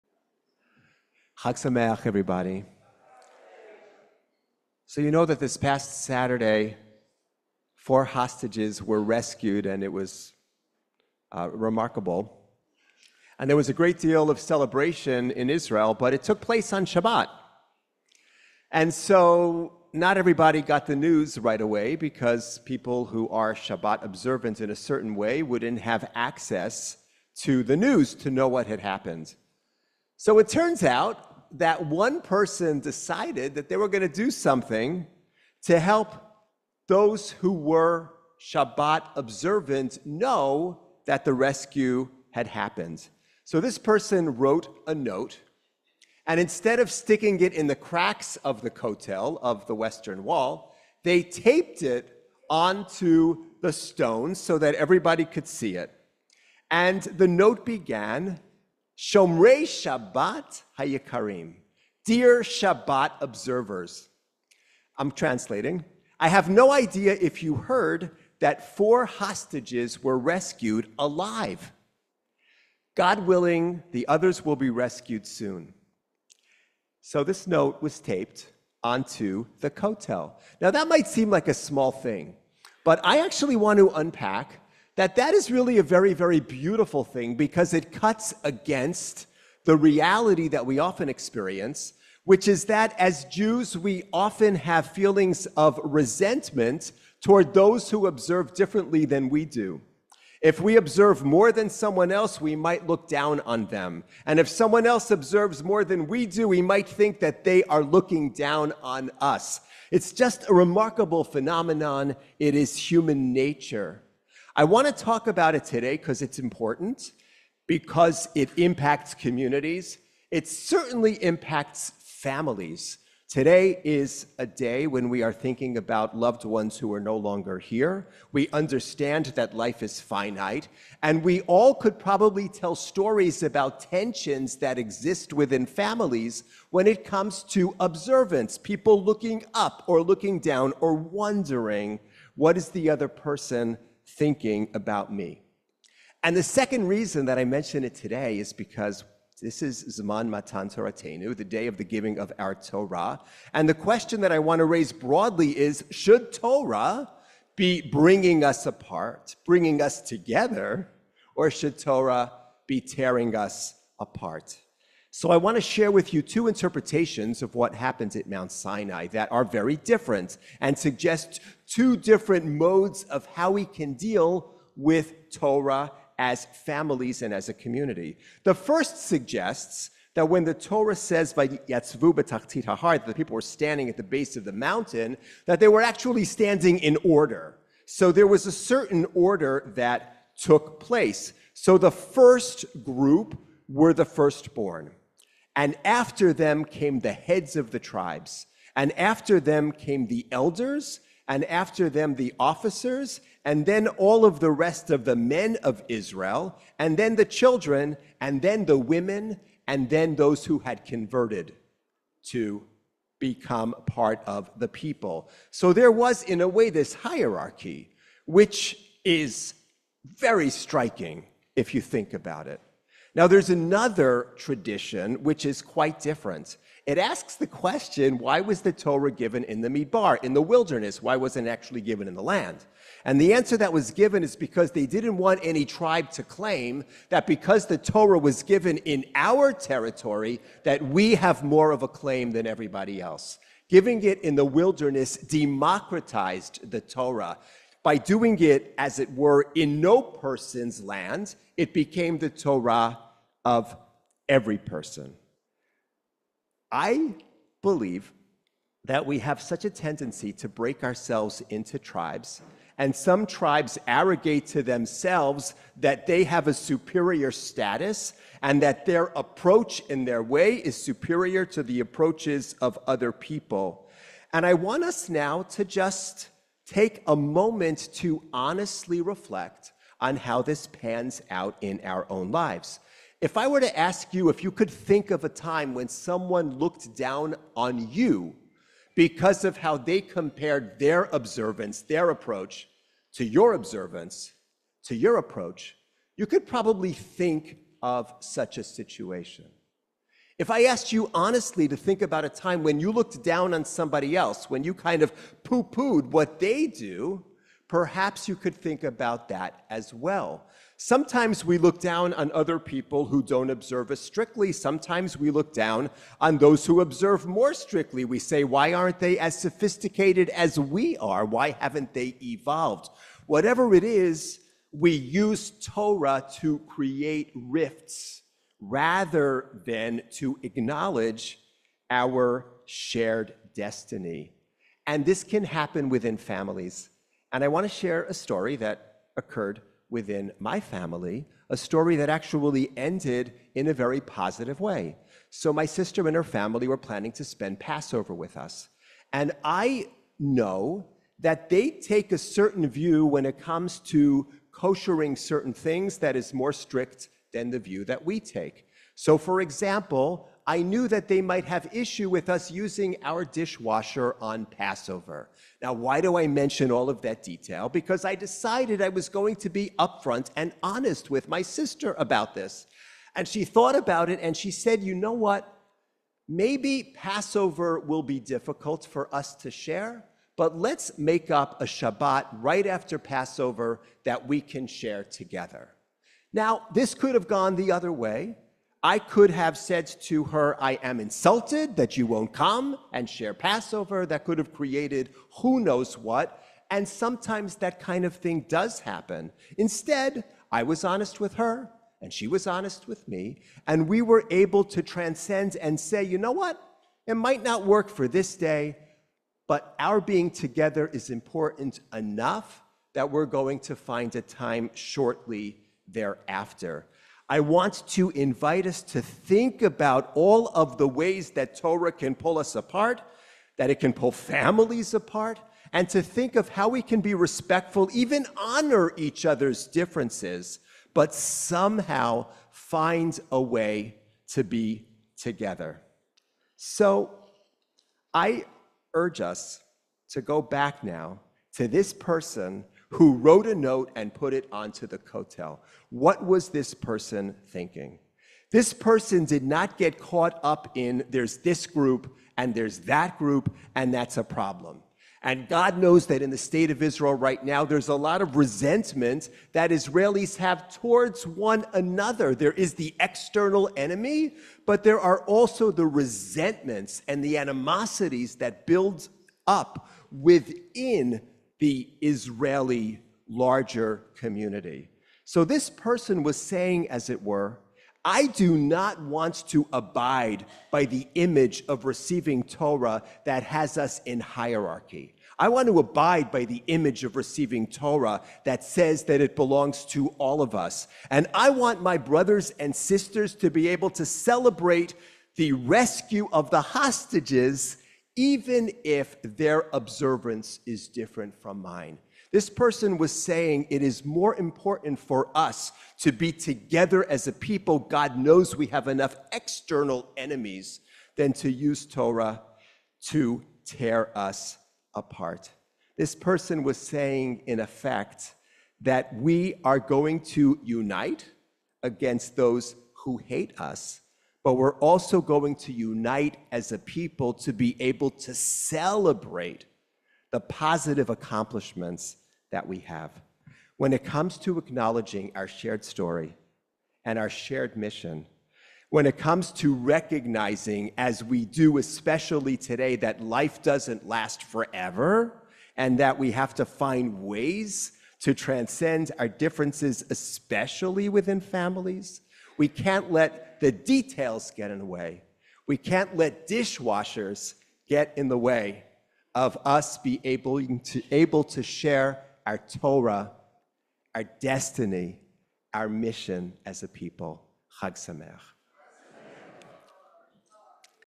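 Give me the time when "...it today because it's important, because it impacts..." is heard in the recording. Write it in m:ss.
1:55.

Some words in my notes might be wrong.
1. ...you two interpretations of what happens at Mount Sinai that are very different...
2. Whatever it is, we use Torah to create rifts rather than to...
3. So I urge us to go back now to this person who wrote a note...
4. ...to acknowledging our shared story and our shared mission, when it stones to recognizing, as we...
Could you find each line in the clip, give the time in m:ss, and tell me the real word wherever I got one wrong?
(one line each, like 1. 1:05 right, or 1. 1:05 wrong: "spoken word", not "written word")
1. 2:46 right
2. 5:23 right
3. 7:16 right
4. 8:54 wrong: "comes", not "stones".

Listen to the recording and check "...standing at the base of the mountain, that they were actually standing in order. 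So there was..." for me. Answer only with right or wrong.
right.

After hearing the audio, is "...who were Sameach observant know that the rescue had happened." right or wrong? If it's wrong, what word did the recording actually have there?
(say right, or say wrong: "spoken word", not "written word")
wrong: "Shabbat", not "Sameach".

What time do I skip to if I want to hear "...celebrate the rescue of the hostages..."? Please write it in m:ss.
8:14.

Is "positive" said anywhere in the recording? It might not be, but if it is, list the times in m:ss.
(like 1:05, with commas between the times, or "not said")
5:44, 8:50.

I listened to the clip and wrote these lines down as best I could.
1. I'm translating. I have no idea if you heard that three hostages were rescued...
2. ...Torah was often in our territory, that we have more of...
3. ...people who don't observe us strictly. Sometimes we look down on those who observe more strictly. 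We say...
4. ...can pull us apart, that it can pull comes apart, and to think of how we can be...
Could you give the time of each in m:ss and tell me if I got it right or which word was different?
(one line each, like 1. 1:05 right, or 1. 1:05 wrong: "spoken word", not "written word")
1. 1:04 wrong: "four", not "three"
2. 3:57 wrong: "given", not "often"
3. 5:12 right
4. 7:01 wrong: "families", not "comes".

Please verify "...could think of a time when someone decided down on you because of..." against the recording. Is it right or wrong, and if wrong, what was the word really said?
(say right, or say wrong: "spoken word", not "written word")
wrong: "looked", not "decided".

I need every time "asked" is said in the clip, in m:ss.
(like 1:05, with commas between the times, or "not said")
5:00.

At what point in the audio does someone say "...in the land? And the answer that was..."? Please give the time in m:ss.
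3:52.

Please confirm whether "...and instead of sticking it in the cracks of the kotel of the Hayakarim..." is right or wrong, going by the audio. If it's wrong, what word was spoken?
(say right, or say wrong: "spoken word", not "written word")
wrong: "Western", not "Hayakarim".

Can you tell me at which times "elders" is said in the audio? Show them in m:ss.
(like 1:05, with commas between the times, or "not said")
3:20.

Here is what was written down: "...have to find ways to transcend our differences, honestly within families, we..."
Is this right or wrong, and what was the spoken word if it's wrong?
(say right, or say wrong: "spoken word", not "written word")
wrong: "especially", not "honestly".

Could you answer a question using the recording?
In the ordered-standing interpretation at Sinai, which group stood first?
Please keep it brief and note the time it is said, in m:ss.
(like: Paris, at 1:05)
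The firstborn, at 3:13.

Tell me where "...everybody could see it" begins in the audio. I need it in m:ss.
0:54.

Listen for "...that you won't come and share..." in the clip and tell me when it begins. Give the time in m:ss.
6:31.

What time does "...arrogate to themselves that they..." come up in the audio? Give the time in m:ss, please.
4:23.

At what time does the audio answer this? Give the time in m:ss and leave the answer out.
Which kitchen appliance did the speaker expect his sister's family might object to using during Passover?
6:03.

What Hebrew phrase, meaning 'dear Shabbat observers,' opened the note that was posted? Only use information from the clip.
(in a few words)
Shomrei Shabbat Hayakarim.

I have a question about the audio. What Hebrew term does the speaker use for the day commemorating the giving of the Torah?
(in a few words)
Zman Matan Toratenu.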